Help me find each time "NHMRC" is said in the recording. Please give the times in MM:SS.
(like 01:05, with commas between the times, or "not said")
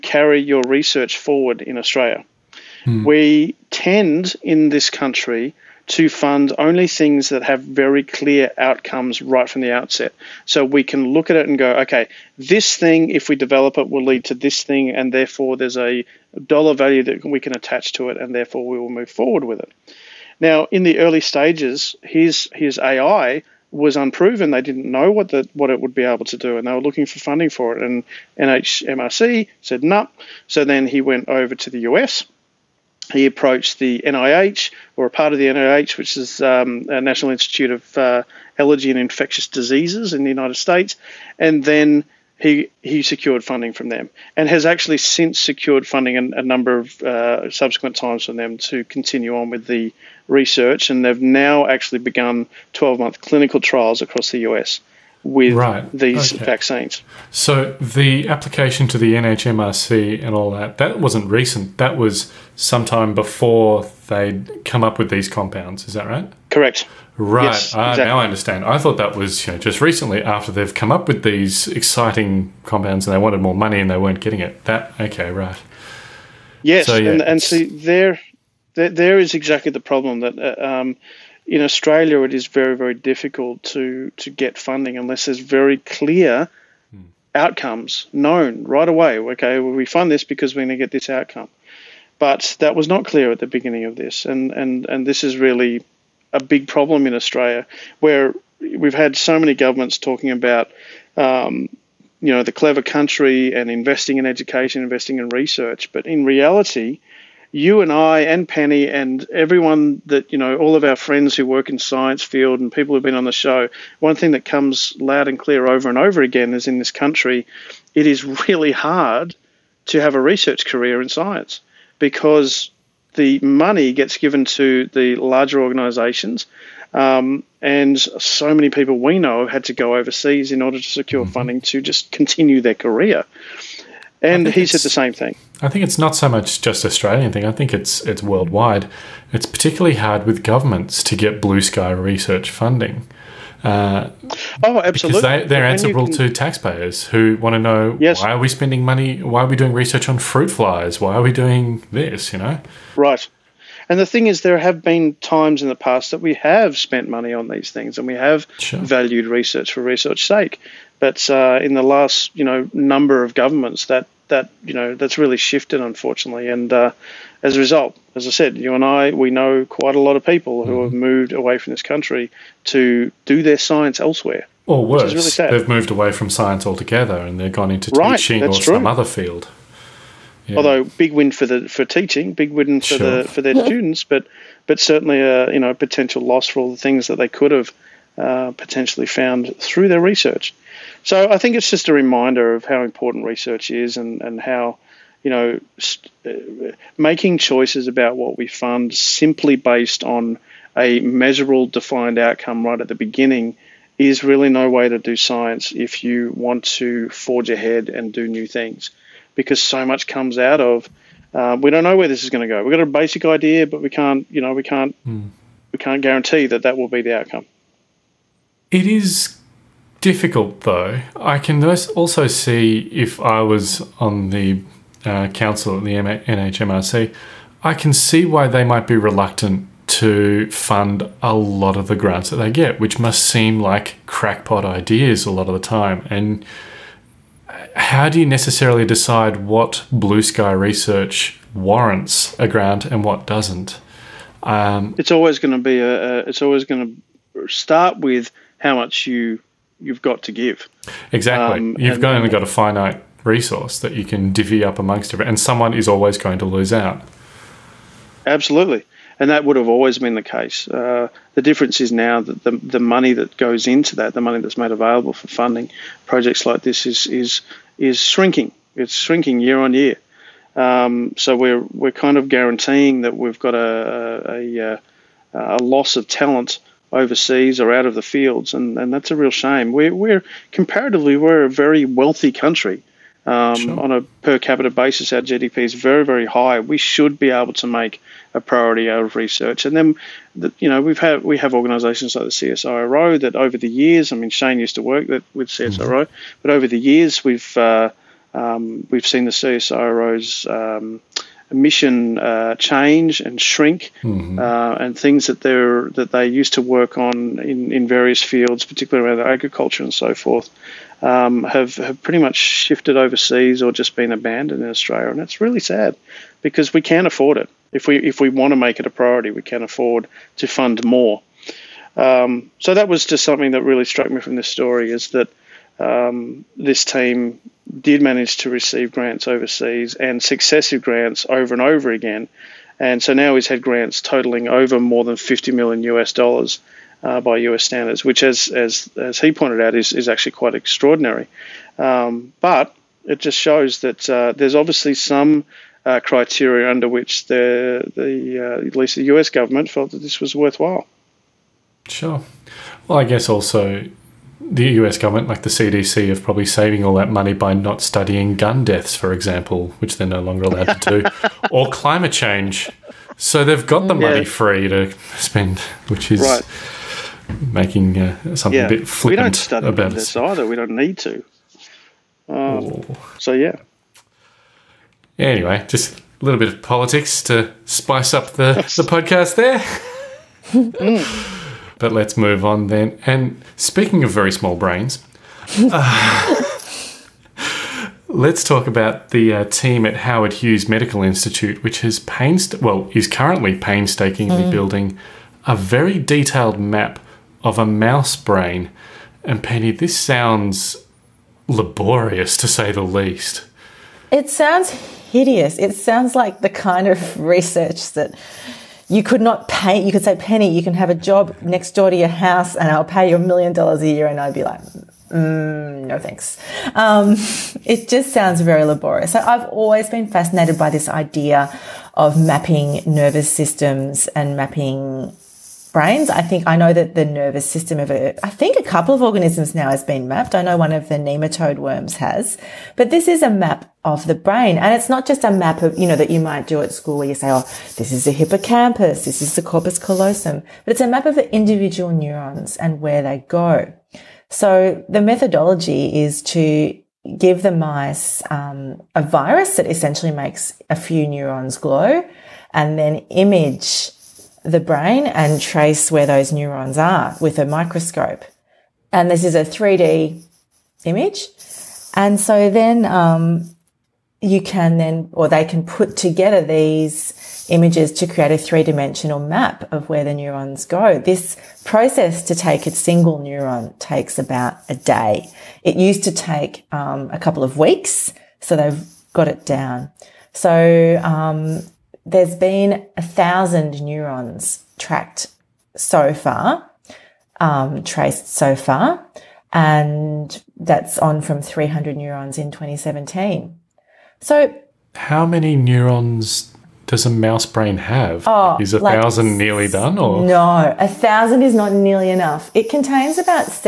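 00:28, 00:59, 03:45.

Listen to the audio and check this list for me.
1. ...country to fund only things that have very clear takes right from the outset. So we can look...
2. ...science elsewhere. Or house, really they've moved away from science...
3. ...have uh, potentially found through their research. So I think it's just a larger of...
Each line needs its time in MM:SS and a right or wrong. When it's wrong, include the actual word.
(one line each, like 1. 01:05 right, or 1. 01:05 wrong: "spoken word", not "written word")
1. 00:04 wrong: "outcomes", not "takes"
2. 02:53 wrong: "worse", not "house"
3. 03:07 wrong: "reminder", not "larger".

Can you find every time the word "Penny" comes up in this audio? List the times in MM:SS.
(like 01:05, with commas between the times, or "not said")
01:48, 06:39, 06:50.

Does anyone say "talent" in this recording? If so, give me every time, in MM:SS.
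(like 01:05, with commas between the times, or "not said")
04:36.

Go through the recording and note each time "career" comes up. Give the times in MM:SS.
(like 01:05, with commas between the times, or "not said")
02:00, 02:12.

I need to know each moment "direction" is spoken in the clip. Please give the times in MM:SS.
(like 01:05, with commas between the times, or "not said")
not said.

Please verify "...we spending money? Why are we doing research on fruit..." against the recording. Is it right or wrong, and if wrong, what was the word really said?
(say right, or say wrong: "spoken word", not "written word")
right.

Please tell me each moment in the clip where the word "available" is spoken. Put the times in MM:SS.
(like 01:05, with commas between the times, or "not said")
04:24.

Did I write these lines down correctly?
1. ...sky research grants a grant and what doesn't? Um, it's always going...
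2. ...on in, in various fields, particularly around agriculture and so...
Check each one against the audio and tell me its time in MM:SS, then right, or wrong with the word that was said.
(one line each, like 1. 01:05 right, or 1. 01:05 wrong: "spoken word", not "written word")
1. 04:00 wrong: "warrants", not "grants"
2. 05:06 right.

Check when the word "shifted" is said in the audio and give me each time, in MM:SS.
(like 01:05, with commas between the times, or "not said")
02:45, 05:12.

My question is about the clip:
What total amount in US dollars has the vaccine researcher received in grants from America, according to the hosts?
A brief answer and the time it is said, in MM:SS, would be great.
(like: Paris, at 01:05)
more than 50 million US dollars, at 05:34.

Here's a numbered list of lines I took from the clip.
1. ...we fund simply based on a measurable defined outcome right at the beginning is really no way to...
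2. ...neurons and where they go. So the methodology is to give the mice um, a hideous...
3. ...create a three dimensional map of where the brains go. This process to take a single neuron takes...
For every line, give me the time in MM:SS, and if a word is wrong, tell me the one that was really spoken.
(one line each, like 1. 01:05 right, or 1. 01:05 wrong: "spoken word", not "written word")
1. 03:18 right
2. 07:21 wrong: "virus", not "hideous"
3. 07:48 wrong: "neurons", not "brains".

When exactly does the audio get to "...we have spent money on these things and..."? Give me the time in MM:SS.
02:36.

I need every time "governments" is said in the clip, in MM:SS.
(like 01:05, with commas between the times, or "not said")
01:39, 02:20, 02:43, 05:49, 05:54.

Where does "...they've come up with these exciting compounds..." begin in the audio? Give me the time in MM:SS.
01:10.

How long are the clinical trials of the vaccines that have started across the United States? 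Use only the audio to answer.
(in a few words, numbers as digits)
12 months.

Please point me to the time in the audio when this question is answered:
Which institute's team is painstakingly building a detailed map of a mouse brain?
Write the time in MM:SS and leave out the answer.
06:29.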